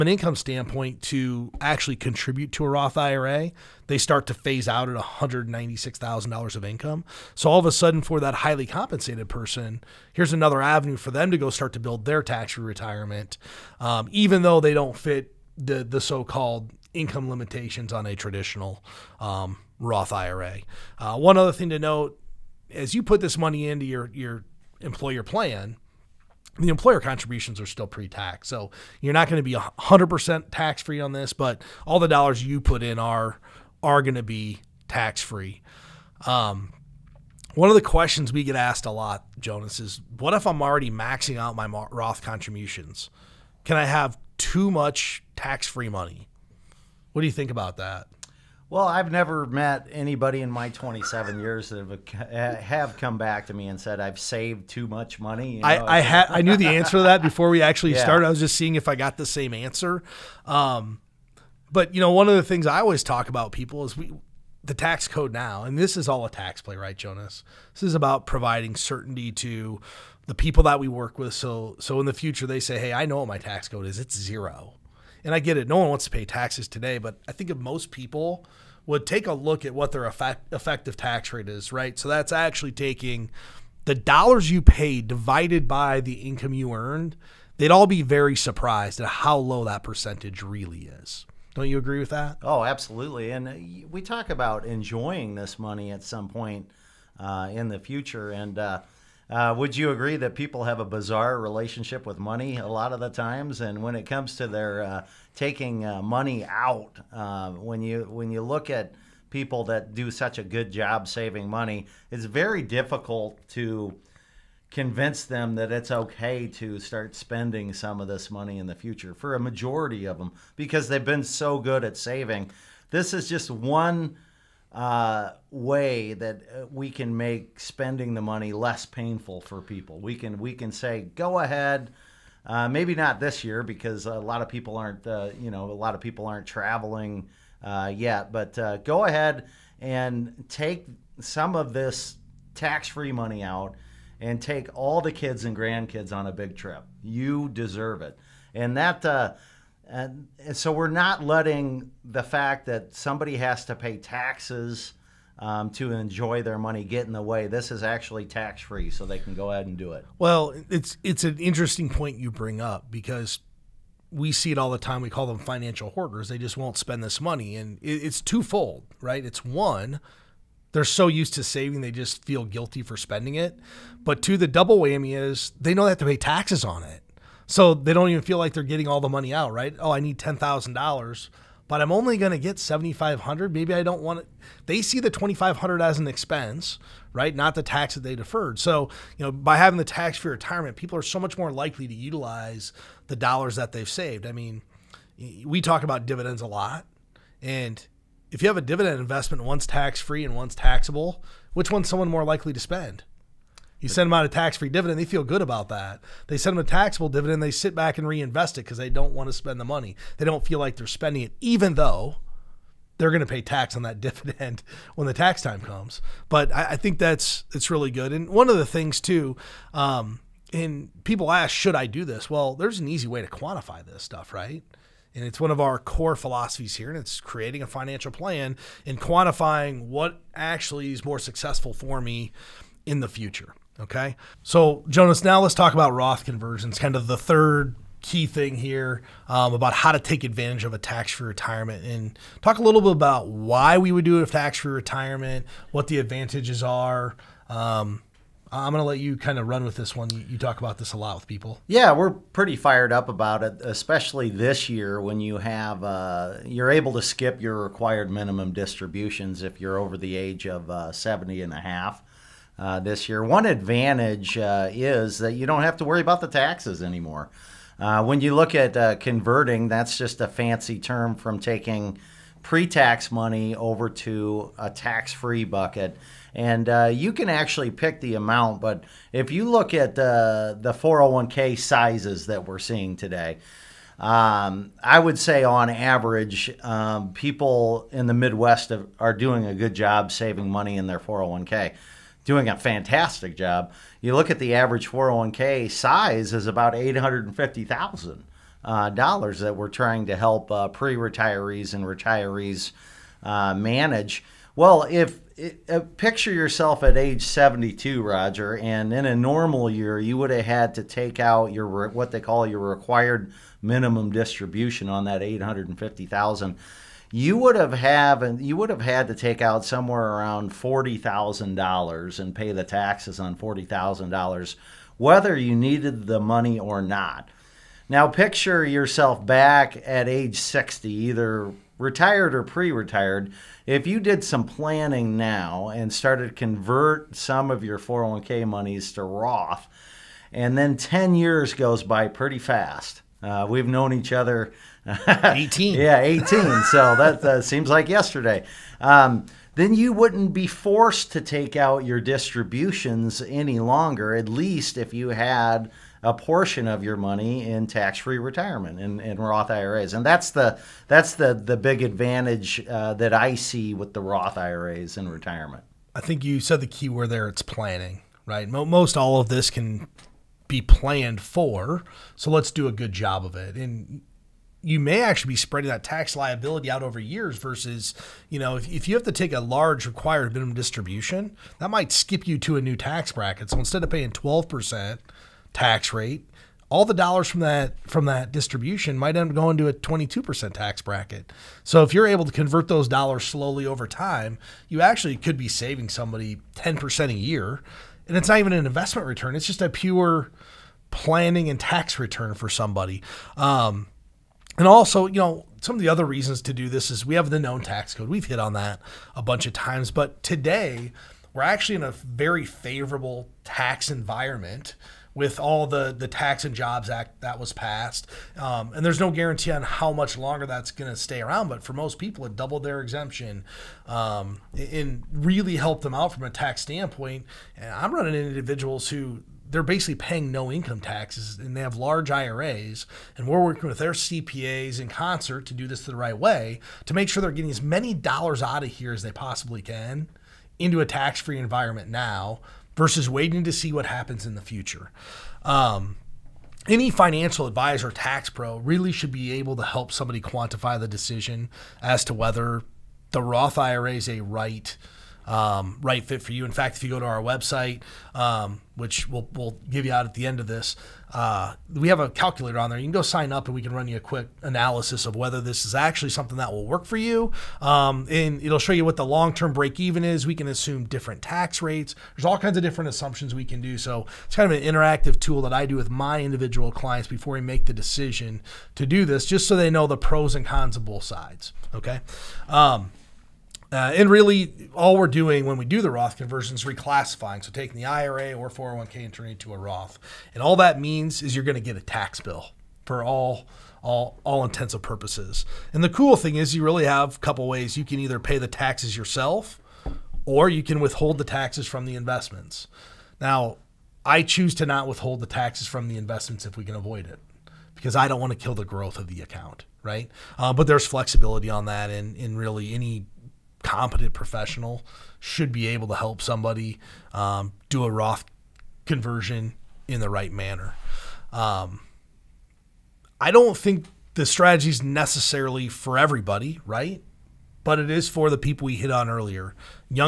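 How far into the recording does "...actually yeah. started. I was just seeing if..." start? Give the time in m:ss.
0:57.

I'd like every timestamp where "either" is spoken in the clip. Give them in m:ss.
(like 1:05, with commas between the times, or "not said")
5:30, 8:17.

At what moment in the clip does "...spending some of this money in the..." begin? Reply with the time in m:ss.
1:57.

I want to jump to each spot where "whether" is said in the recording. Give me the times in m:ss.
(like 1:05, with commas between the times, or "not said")
5:24, 7:32, 7:45.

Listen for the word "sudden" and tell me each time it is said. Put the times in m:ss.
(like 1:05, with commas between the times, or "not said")
0:07.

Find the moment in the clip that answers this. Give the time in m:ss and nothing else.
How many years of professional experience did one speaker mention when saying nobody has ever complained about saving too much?
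0:50.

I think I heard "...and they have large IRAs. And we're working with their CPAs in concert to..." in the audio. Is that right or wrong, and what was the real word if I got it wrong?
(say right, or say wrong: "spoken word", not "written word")
right.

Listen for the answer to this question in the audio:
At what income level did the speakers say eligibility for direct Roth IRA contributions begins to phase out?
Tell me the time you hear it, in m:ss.
0:04.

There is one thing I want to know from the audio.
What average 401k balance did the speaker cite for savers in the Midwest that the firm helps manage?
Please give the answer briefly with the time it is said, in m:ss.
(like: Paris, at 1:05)
$850,000, at 4:56.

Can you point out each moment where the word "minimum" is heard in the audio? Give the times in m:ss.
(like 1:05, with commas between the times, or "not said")
4:18, 5:13, 6:20.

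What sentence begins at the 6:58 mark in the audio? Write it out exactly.
Um, and there's no guarantee on how much longer that's going to stay around.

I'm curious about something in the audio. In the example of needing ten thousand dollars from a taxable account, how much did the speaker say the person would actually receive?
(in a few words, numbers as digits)
$7,500.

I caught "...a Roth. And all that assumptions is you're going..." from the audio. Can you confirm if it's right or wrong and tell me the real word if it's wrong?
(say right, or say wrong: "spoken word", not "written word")
wrong: "means", not "assumptions".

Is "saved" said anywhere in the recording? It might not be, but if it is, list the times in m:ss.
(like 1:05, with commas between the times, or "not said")
0:54, 3:13.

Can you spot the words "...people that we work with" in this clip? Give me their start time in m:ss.
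1:10.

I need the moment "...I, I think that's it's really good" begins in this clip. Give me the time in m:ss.
3:36.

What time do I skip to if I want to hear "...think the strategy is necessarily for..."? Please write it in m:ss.
8:43.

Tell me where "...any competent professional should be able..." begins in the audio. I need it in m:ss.
8:32.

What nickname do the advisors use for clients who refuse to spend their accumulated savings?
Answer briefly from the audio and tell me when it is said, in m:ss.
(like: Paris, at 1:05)
financial hoarders, at 2:45.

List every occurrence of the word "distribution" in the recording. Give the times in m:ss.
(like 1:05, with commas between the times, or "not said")
4:18, 5:14, 5:51, 6:20, 6:28.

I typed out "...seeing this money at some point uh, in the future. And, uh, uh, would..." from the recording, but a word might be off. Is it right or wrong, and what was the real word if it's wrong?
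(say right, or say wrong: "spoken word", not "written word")
wrong: "enjoying", not "seeing".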